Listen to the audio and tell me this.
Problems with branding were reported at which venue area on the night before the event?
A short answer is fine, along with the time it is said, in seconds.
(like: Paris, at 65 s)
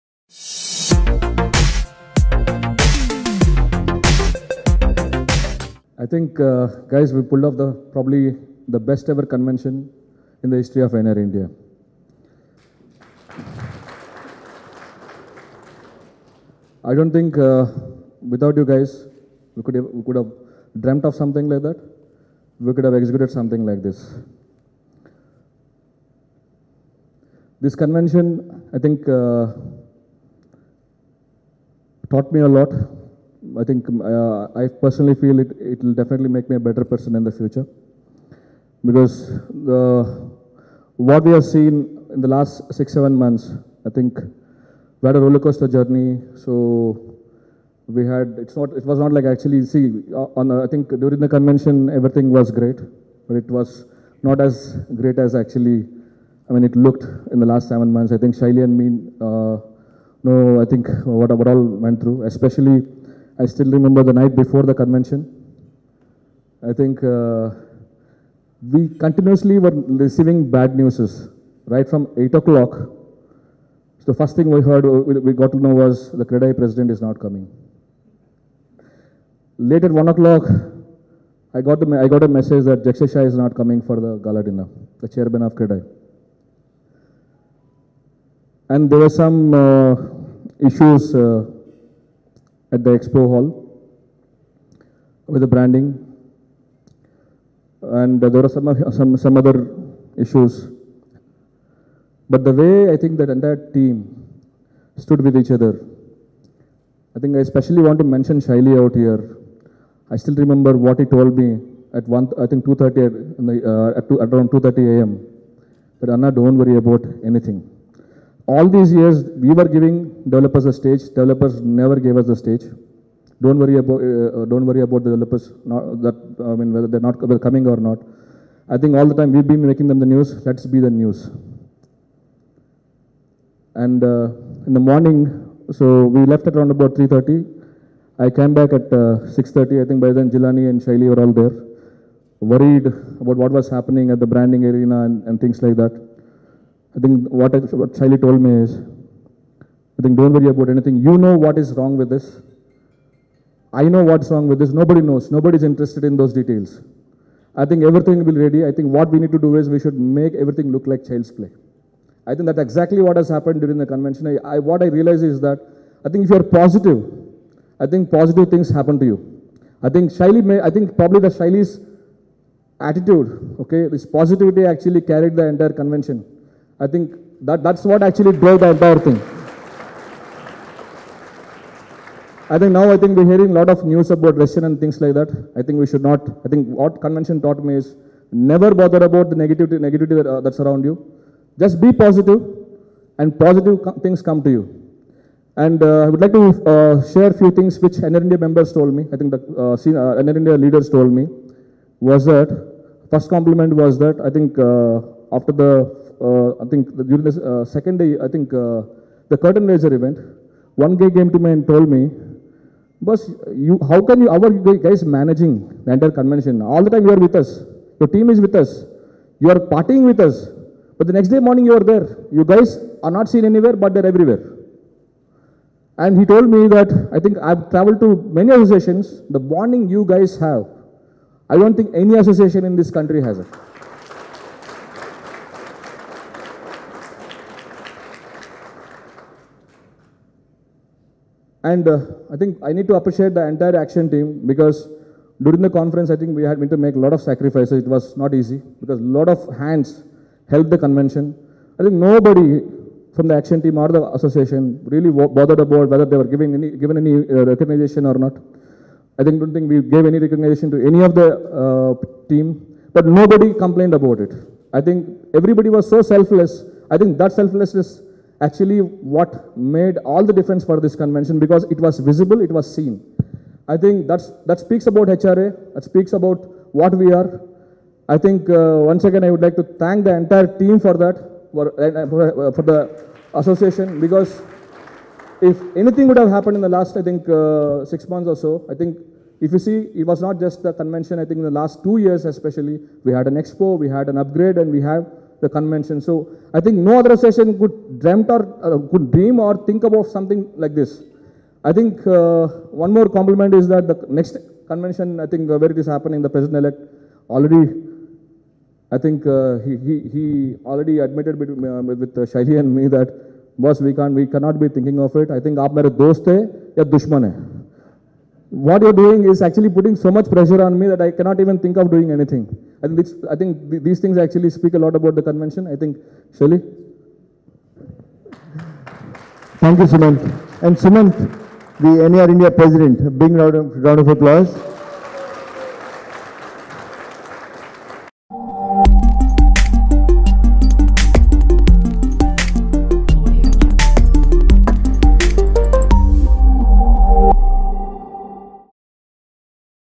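expo hall, at 92 s.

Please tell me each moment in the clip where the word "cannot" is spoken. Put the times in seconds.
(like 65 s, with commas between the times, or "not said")
314 s, 321 s.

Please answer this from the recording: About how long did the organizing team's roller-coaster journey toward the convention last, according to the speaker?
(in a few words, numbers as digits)
6-7 months.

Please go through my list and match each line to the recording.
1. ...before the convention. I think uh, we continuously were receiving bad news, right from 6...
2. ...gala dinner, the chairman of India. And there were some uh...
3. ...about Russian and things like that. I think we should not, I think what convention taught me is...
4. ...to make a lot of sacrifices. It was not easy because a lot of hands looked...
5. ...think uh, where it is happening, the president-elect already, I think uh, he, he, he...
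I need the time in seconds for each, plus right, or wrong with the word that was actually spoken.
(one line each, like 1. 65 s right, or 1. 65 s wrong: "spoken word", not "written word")
1. 64 s wrong: "8", not "6"
2. 84 s wrong: "CREDAI", not "India"
3. 184 s right
4. 246 s wrong: "helped", not "looked"
5. 305 s right.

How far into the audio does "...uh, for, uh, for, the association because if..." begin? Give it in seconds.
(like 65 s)
281 s.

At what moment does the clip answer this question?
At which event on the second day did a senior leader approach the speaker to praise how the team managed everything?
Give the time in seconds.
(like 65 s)
209 s.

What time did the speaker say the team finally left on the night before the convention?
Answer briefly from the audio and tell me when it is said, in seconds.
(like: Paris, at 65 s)
3:30, at 136 s.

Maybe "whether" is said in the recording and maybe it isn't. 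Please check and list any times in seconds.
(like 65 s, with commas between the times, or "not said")
126 s, 255 s.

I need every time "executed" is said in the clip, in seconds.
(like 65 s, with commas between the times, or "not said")
22 s.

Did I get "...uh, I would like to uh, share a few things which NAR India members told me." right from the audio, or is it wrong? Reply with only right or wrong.
right.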